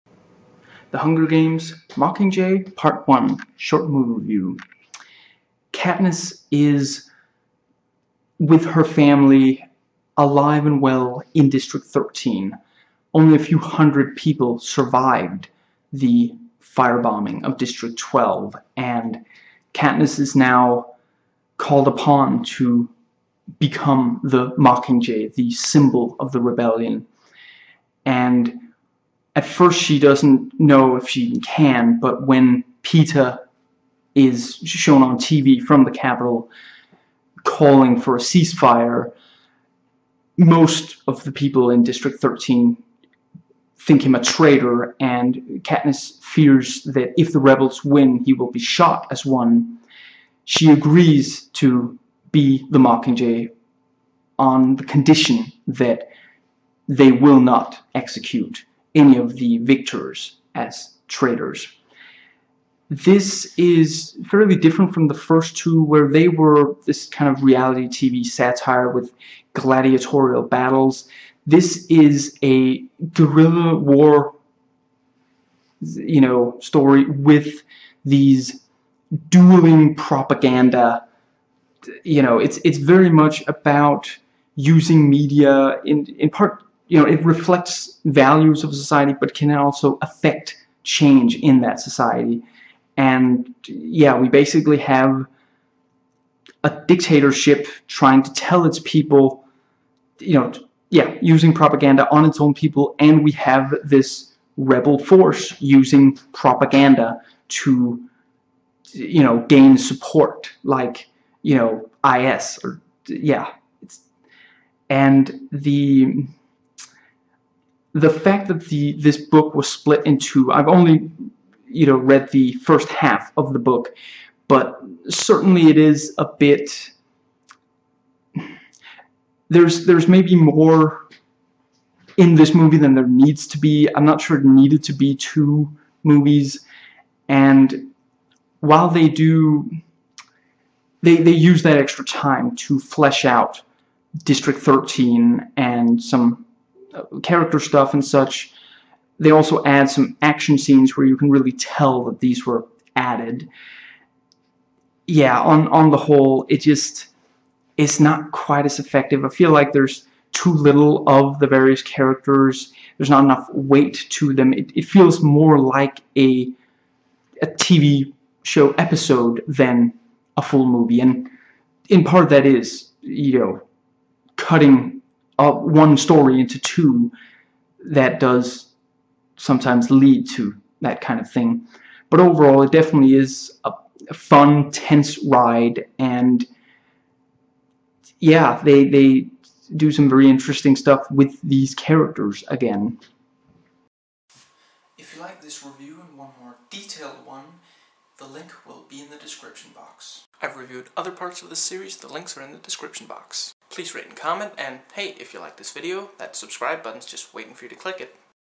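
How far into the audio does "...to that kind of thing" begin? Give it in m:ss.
3:00.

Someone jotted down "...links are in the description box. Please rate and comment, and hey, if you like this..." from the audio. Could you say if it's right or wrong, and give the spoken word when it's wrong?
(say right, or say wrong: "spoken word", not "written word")
right.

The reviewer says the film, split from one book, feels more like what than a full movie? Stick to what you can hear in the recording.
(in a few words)
a TV show episode.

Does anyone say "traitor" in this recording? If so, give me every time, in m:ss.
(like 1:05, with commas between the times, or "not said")
0:44, 1:01.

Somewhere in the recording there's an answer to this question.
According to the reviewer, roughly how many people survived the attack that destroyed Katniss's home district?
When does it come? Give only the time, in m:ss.
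0:13.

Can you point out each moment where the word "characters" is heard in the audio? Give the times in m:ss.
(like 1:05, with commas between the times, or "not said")
2:27, 2:41, 3:11.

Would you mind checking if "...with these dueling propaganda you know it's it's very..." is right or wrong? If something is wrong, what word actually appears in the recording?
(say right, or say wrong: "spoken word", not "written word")
right.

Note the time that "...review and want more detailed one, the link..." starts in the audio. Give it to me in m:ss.
3:15.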